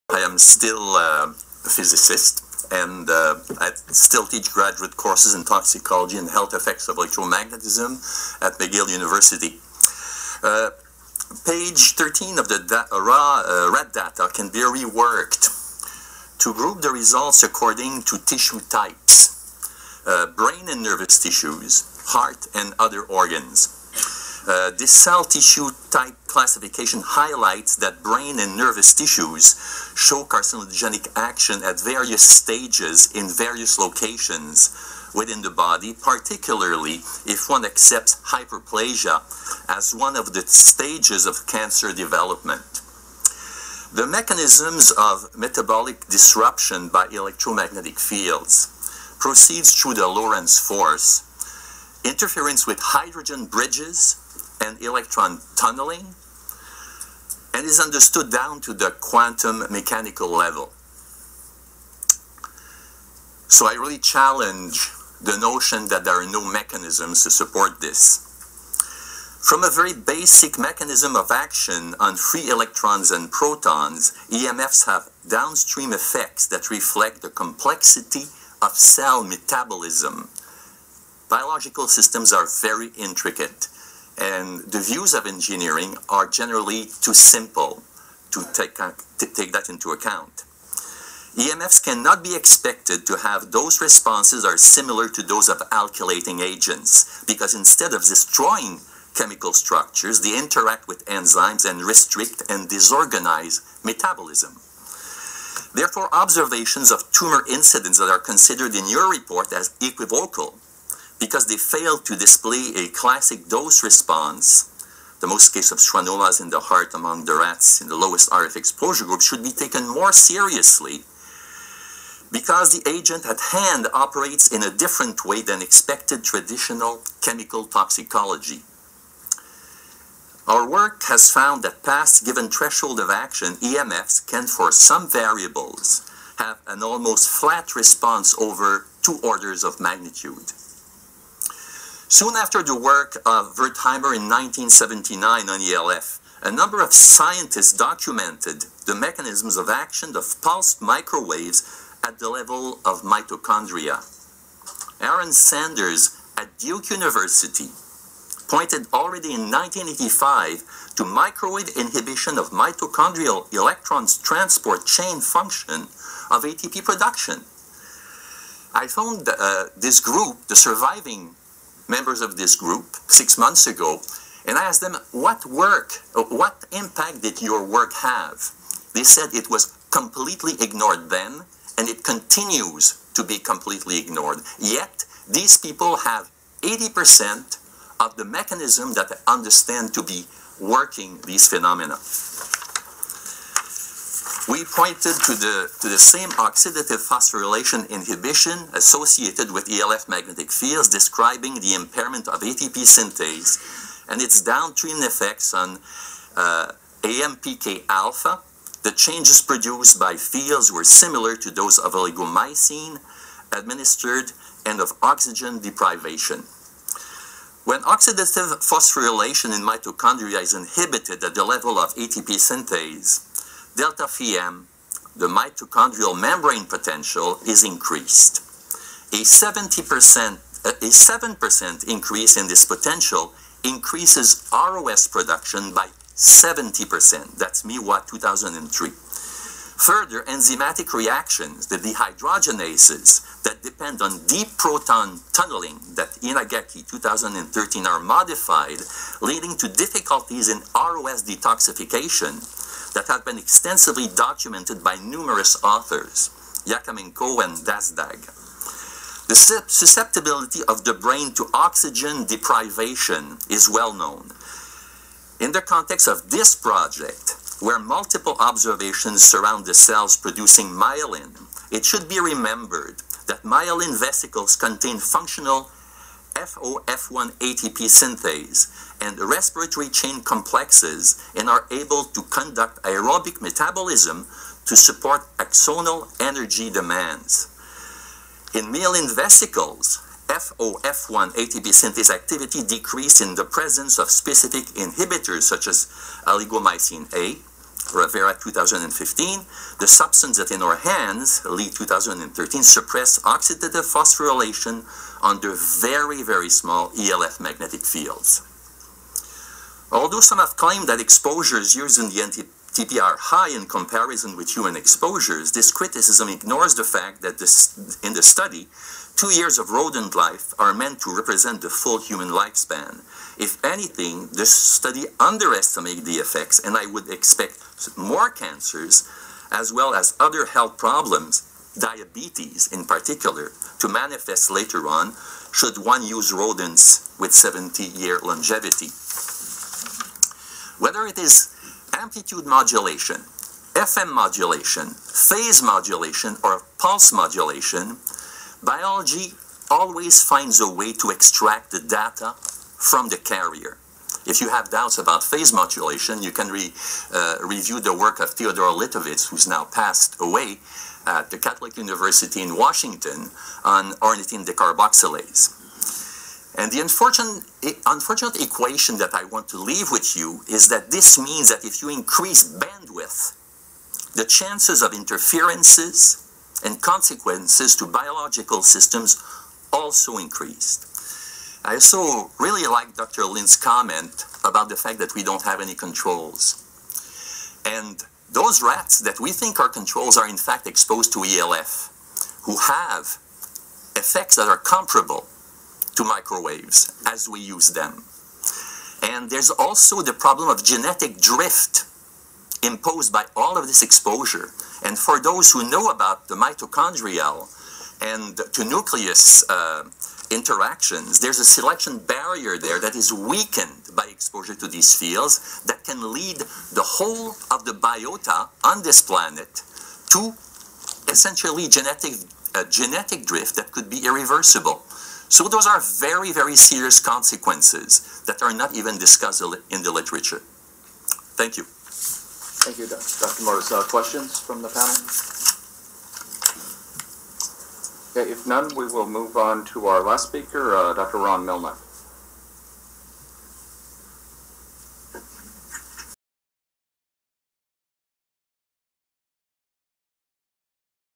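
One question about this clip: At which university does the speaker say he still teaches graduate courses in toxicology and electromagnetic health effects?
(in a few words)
McGill University.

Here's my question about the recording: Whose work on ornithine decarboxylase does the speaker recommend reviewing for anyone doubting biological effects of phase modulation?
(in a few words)
Theodore Litovitz.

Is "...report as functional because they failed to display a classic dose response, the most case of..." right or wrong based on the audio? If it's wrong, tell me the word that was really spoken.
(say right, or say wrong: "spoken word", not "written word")
wrong: "equivocal", not "functional".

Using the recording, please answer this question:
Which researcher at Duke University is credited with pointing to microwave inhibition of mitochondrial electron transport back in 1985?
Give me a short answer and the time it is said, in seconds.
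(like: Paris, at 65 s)
Aaron Sanders, at 154 s.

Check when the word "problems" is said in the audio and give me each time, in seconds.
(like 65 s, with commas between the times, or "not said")
330 s, 400 s.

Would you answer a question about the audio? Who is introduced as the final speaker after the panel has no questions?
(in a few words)
Ron Melnick.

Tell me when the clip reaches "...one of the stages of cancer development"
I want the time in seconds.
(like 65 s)
39 s.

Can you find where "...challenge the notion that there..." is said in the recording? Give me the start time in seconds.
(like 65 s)
63 s.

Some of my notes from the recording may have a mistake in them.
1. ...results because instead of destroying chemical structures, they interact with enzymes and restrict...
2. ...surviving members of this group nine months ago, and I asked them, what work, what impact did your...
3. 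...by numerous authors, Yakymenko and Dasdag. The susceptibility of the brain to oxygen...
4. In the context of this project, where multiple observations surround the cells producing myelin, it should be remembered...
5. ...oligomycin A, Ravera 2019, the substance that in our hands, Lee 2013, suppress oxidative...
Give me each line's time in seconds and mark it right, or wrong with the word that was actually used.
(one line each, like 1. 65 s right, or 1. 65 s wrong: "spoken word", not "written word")
1. 96 s wrong: "agents", not "results"
2. 170 s wrong: "six", not "nine"
3. 254 s right
4. 265 s right
5. 296 s wrong: "2015", not "2019".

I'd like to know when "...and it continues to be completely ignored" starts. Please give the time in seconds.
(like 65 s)
181 s.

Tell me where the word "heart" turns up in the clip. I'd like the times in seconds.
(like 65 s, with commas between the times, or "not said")
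22 s, 116 s.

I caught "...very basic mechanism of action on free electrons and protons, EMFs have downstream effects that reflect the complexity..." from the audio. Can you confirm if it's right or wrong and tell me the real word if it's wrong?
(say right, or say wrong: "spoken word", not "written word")
right.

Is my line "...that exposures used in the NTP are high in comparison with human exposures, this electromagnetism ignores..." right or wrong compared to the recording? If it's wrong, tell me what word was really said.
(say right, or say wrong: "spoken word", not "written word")
wrong: "criticism", not "electromagnetism".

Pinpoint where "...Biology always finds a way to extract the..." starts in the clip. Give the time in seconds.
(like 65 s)
348 s.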